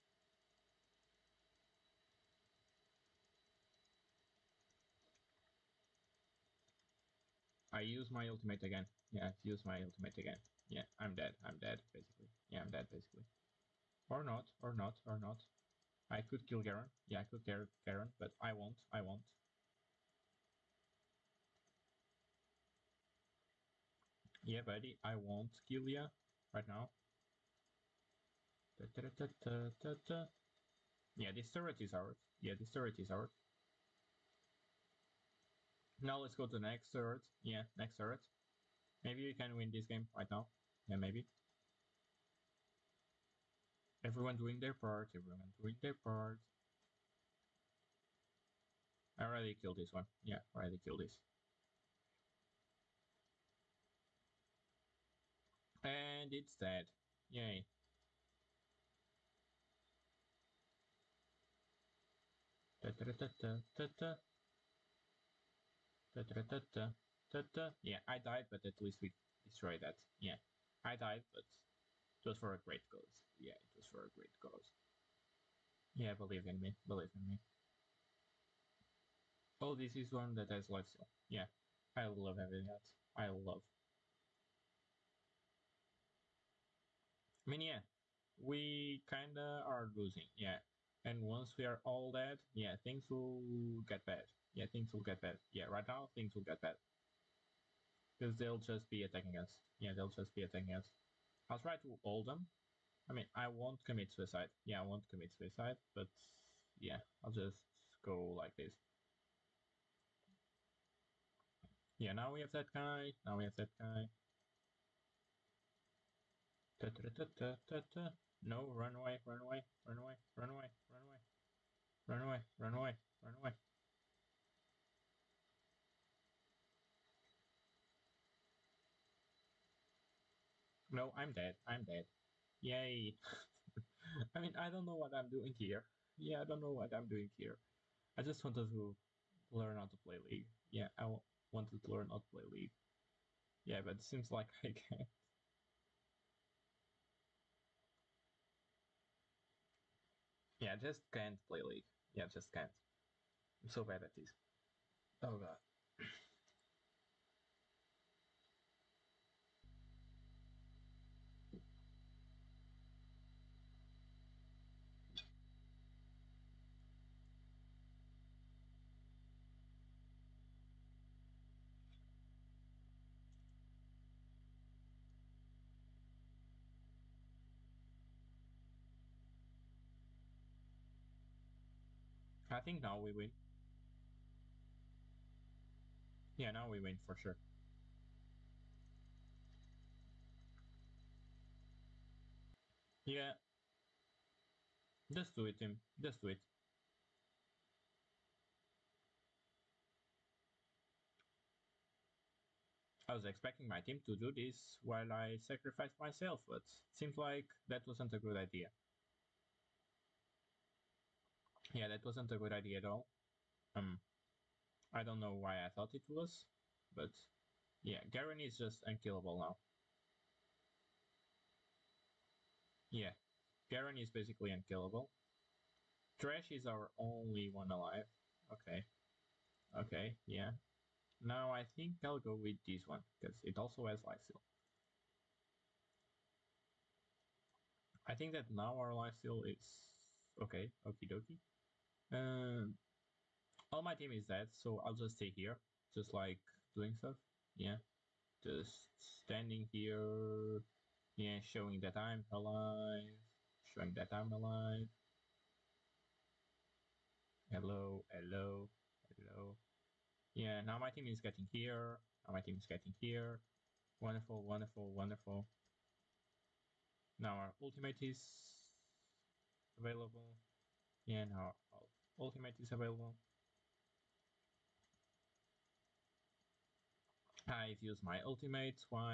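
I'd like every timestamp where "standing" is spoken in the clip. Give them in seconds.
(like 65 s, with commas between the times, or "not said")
249 s.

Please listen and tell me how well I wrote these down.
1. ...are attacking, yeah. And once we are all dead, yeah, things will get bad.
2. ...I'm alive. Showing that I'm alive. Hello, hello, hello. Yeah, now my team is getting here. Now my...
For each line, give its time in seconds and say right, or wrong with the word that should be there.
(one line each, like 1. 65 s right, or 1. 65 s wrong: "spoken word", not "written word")
1. 89 s wrong: "losing", not "attacking"
2. 251 s right.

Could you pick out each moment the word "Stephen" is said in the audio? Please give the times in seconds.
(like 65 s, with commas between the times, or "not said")
not said.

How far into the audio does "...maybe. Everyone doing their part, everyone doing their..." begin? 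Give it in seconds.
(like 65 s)
40 s.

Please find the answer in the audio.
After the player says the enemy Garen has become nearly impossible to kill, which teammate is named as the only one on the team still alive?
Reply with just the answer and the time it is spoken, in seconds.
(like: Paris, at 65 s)
Trash, at 226 s.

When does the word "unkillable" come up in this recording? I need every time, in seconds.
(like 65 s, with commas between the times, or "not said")
218 s, 224 s.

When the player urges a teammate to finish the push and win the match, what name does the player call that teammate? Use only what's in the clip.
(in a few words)
Tim.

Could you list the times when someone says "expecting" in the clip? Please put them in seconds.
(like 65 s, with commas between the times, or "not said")
203 s.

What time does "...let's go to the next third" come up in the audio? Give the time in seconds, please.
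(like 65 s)
36 s.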